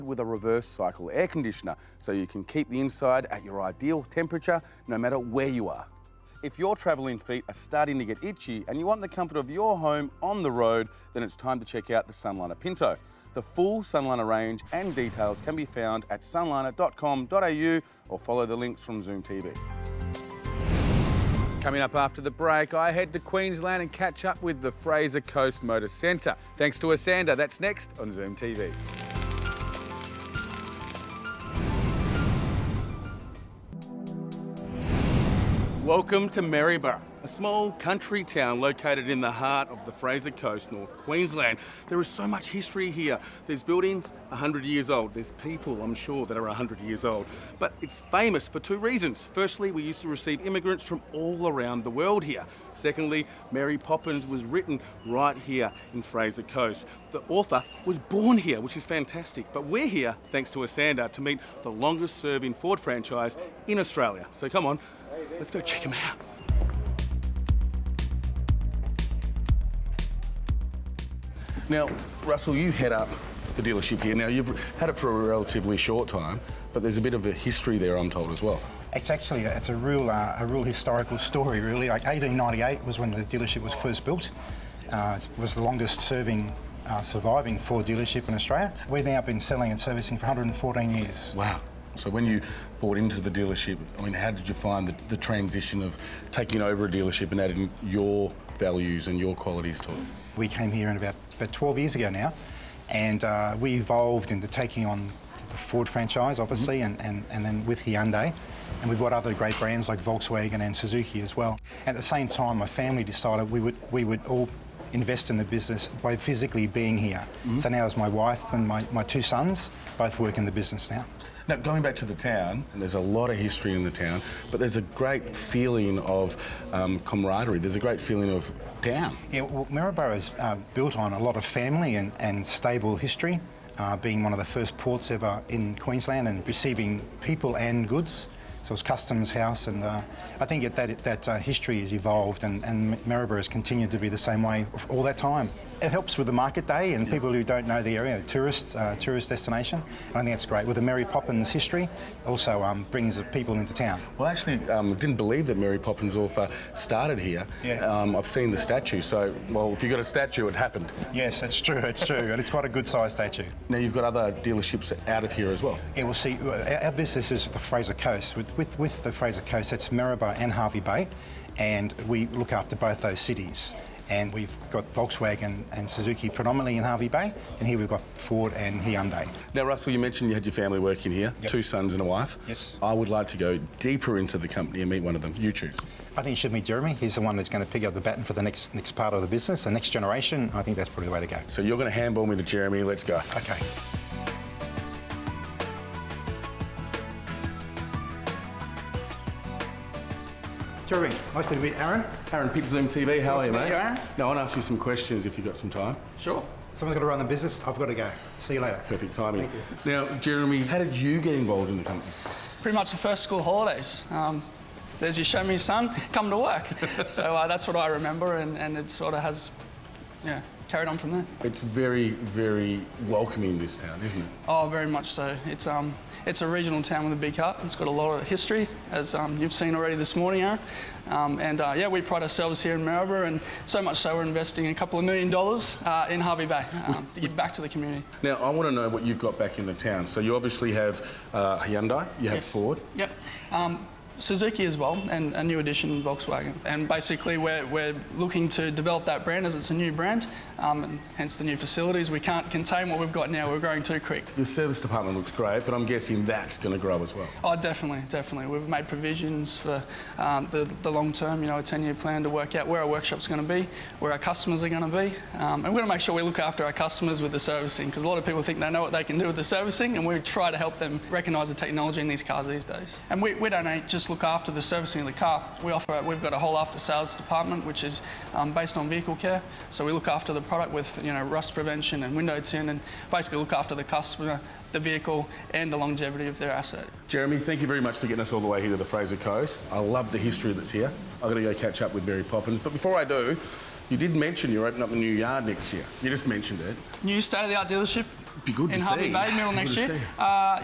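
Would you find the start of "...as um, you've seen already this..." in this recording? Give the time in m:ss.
3:48.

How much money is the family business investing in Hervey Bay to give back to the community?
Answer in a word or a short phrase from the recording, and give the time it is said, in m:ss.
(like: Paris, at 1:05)
a couple of million dollars, at 3:54.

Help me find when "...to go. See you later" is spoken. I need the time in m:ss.
3:27.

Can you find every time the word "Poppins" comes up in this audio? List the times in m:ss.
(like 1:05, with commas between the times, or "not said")
0:53, 2:31, 2:35, 4:52.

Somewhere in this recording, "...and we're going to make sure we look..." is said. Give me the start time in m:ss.
4:25.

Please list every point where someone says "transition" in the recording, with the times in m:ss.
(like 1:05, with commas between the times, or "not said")
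1:35.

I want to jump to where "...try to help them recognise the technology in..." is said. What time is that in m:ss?
4:30.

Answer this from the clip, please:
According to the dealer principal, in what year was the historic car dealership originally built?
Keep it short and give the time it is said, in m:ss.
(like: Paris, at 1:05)
1898, at 1:22.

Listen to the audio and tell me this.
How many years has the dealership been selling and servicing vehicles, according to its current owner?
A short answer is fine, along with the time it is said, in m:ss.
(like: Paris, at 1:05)
114, at 1:30.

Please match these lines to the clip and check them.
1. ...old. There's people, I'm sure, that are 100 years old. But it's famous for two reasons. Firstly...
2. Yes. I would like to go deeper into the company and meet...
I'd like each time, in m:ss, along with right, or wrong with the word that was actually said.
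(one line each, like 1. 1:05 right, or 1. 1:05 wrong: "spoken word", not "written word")
1. 0:44 right
2. 3:02 right.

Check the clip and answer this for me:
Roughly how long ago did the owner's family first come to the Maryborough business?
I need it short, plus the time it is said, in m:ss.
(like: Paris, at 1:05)
12 years, at 1:41.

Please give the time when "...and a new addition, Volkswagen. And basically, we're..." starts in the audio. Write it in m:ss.
4:05.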